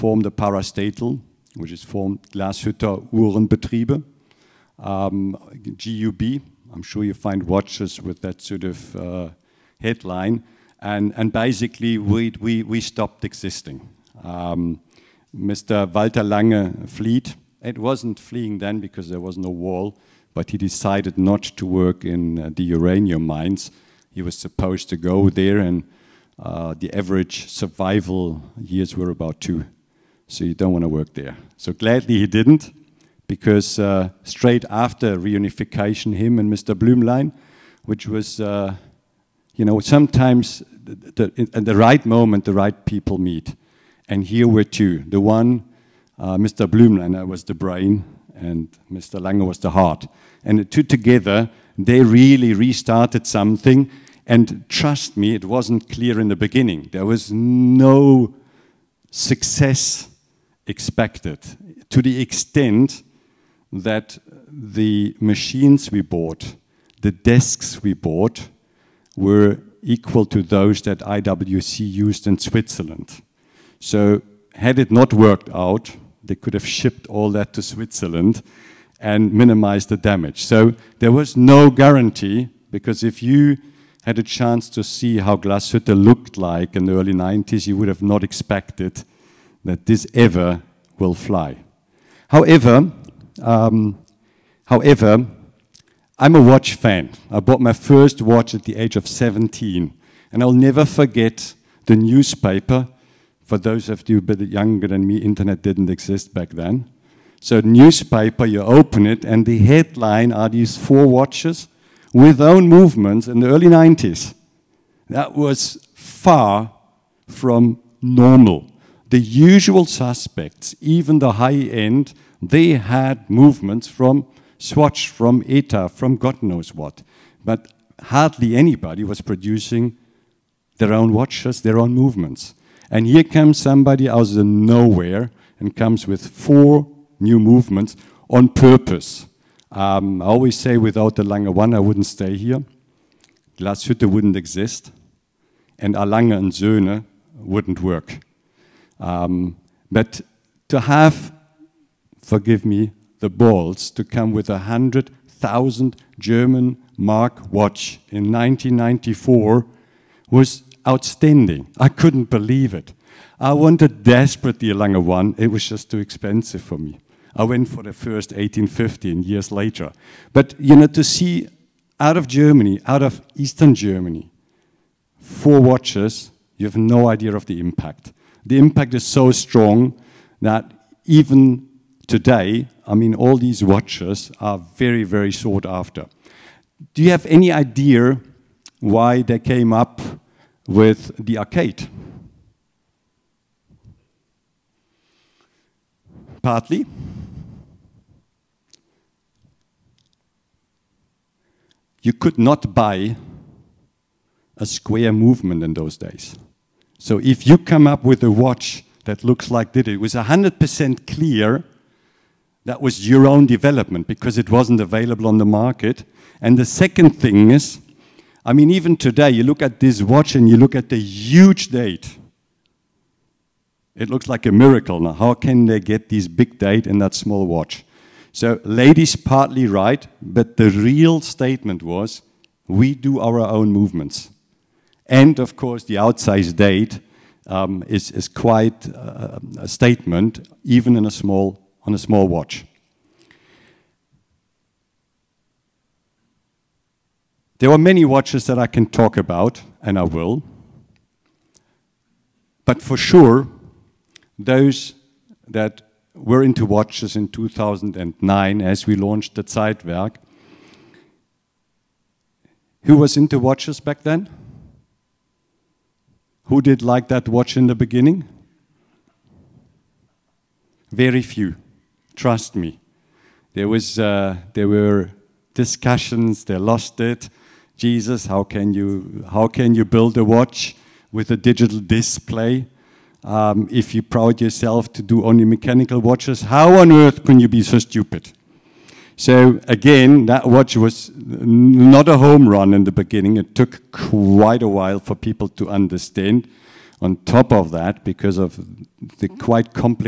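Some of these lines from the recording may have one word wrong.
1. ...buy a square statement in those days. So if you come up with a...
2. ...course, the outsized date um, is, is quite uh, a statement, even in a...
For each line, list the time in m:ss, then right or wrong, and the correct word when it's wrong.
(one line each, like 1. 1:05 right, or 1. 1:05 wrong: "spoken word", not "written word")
1. 3:22 wrong: "movement", not "statement"
2. 3:55 right.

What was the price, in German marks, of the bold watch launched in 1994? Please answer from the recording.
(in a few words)
100,000 German marks.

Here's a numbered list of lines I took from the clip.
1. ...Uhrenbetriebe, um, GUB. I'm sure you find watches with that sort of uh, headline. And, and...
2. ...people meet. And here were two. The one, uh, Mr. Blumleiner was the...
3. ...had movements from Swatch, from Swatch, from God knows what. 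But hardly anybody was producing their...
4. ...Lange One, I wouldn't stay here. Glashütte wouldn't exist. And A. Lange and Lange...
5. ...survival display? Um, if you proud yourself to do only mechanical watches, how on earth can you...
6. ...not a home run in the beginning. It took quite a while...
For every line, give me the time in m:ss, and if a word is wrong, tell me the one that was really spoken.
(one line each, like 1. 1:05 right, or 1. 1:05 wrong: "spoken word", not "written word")
1. 0:03 right
2. 0:42 right
3. 2:02 wrong: "ETA", not "Swatch"
4. 2:21 wrong: "Söhne", not "Lange"
5. 4:41 wrong: "digital", not "survival"
6. 4:51 right.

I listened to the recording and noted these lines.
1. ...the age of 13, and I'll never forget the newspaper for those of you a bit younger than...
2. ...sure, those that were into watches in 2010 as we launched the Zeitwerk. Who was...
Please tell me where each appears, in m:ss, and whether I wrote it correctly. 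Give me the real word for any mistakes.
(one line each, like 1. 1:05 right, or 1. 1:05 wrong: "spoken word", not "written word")
1. 1:38 wrong: "17", not "13"
2. 4:12 wrong: "2009", not "2010".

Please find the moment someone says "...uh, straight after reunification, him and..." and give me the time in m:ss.
0:33.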